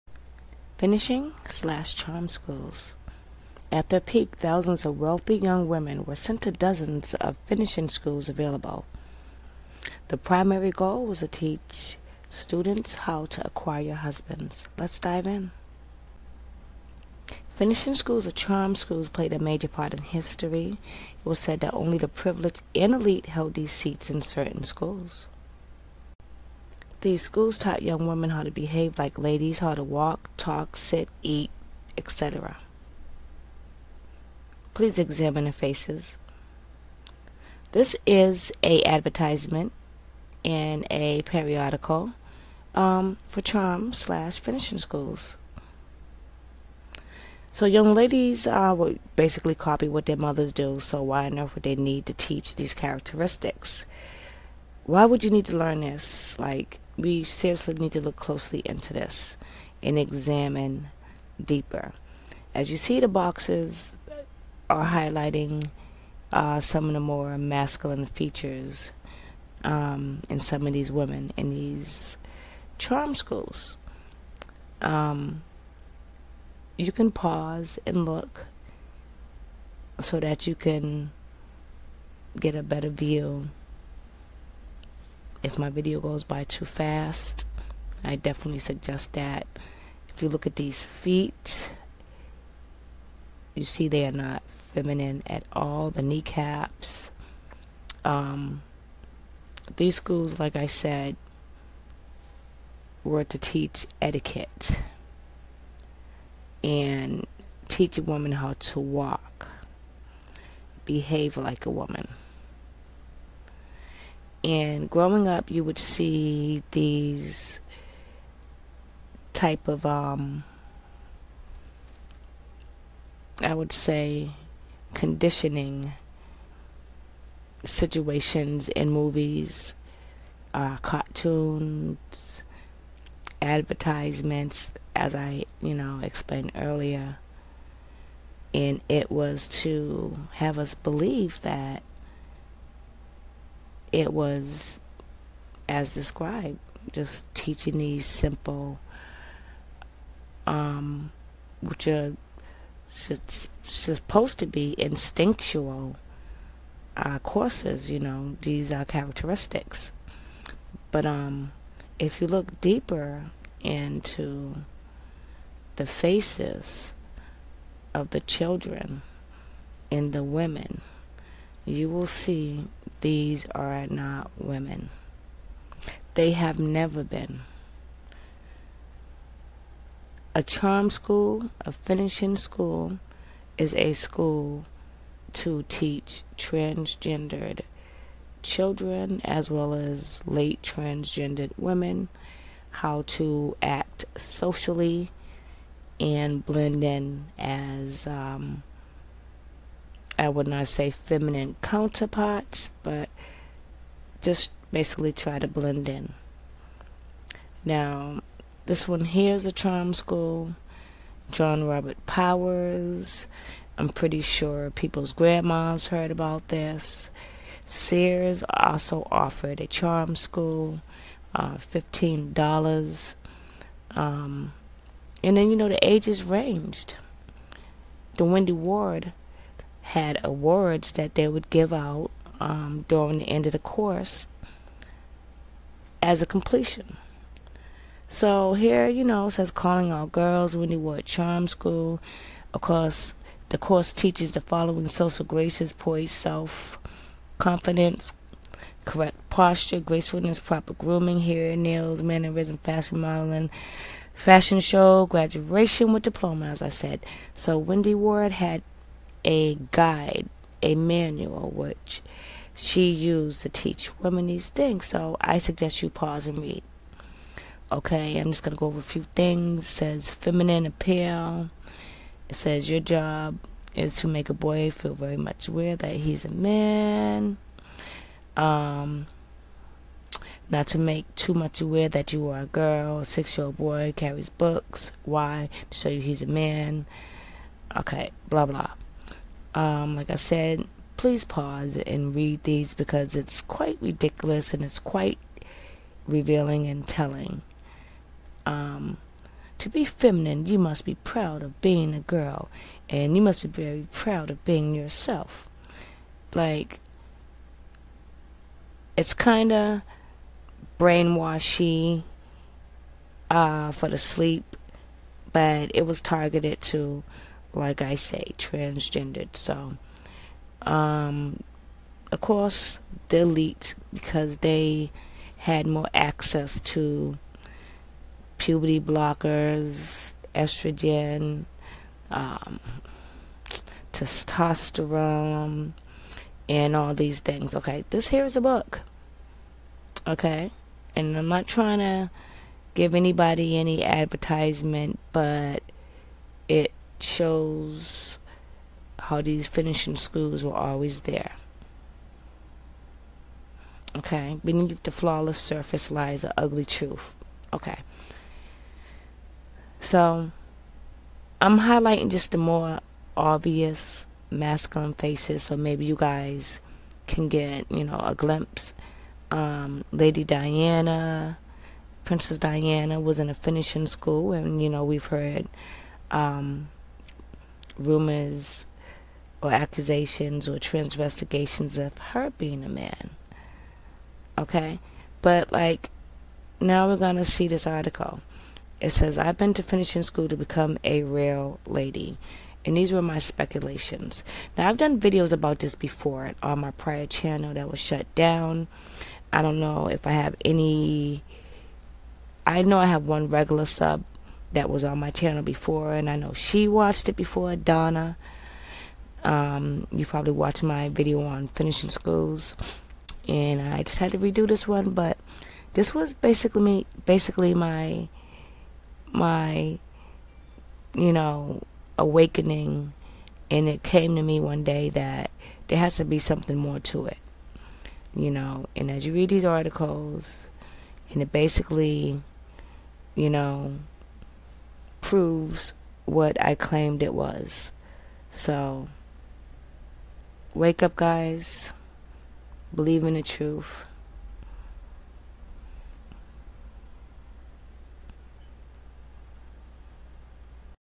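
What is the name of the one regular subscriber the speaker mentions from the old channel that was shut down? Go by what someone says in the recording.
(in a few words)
Donna.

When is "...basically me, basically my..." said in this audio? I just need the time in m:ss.
6:56.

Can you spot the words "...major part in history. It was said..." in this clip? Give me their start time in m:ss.
0:19.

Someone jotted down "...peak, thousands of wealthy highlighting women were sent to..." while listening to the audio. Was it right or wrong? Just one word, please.
wrong.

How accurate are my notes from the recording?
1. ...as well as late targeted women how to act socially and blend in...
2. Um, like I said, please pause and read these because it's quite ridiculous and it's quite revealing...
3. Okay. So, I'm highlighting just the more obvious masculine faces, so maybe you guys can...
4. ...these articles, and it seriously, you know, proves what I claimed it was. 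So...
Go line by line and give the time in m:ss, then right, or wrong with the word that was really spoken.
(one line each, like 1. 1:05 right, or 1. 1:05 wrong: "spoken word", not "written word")
1. 3:09 wrong: "transgendered", not "targeted"
2. 4:49 right
3. 5:57 right
4. 7:09 wrong: "basically", not "seriously".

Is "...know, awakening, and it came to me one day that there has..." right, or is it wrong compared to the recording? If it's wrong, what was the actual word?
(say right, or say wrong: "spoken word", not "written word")
right.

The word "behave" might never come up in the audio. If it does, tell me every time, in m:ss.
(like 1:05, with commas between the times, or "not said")
0:28, 1:50.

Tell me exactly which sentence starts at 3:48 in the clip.
The Wendy Ward had awards that they would give out um, during the end of the course as a completion.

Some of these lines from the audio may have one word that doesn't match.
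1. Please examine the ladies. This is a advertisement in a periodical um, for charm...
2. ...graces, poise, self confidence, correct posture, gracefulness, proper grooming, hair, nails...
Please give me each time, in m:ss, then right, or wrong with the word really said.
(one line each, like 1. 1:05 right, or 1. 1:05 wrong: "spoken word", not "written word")
1. 0:34 wrong: "faces", not "ladies"
2. 4:05 right.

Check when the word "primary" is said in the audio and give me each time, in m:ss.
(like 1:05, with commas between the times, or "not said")
0:10.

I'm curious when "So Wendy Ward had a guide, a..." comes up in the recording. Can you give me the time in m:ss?
4:17.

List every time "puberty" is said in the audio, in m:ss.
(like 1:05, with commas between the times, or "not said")
5:28.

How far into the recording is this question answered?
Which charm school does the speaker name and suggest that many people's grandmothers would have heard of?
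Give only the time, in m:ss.
3:31.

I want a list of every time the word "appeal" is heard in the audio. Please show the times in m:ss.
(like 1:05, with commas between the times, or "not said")
4:30.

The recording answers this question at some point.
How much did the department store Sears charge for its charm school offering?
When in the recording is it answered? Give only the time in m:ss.
3:41.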